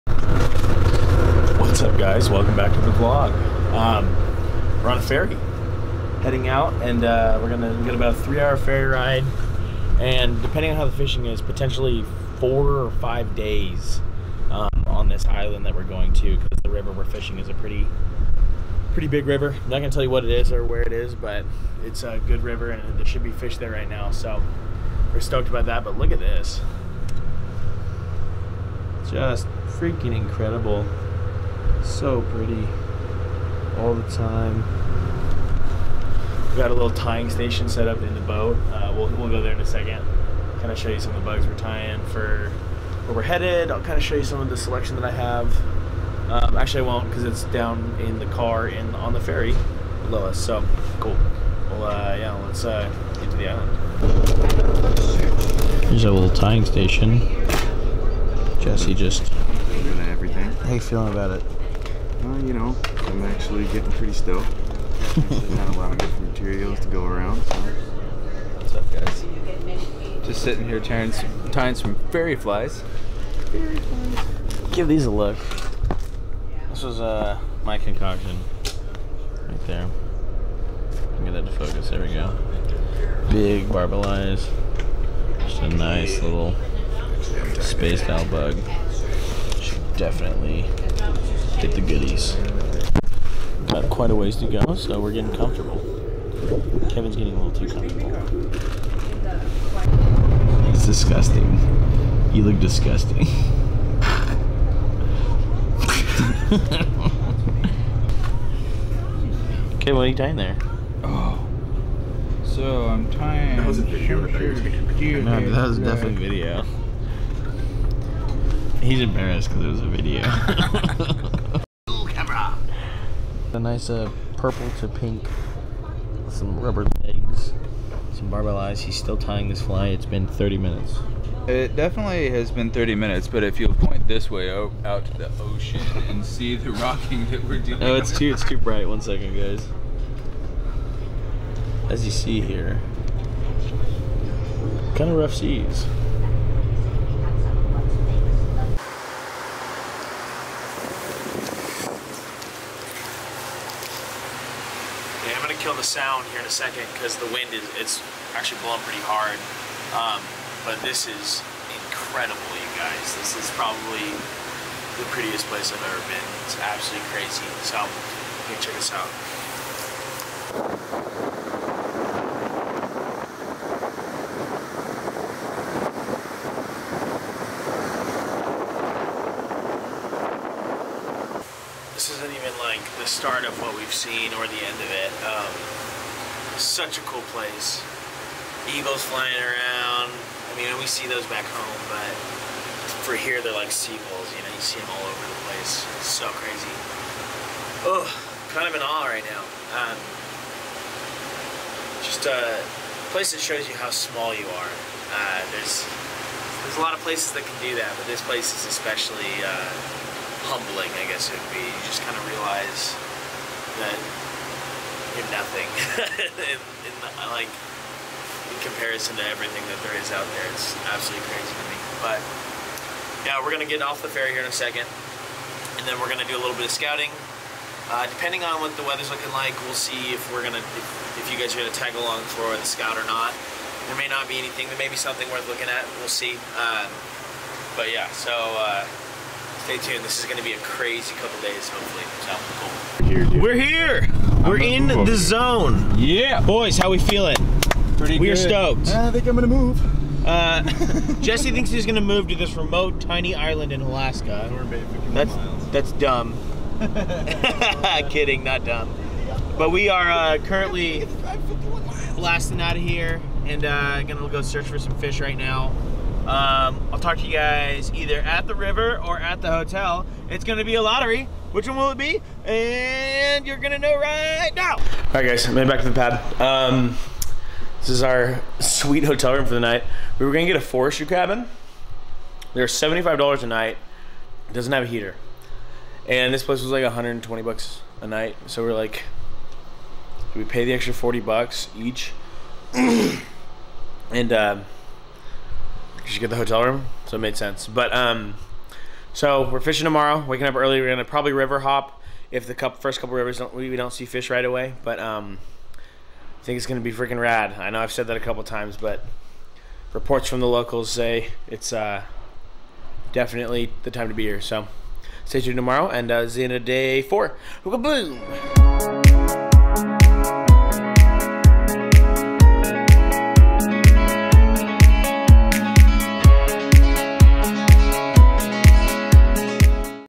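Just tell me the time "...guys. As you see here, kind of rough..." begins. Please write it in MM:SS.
02:19.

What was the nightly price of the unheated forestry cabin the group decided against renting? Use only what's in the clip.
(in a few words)
$75.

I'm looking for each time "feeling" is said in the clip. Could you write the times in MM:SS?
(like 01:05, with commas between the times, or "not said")
01:00, 04:06.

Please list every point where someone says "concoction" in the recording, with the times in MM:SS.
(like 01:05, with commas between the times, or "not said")
01:17.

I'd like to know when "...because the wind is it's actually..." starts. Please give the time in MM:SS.
02:36.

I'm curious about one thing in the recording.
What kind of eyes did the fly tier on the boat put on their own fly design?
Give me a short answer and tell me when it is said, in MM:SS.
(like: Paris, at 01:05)
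Big barbell eyes, at 01:23.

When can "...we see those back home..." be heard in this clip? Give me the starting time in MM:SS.
03:10.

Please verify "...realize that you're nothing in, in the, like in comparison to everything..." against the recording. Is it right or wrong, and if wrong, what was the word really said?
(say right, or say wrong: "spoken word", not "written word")
right.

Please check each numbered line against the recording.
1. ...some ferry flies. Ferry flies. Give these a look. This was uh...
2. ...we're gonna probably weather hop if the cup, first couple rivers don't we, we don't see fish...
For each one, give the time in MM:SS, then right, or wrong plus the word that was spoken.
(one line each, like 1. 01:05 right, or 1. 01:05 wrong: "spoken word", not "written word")
1. 01:11 right
2. 05:00 wrong: "river", not "weather".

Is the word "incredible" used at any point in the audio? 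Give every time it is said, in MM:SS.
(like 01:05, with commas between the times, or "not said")
00:30, 02:41.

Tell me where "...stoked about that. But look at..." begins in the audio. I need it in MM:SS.
00:25.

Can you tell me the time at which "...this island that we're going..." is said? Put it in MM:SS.
00:15.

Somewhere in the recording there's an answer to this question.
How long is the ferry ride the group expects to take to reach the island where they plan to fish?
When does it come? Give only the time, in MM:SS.
00:08.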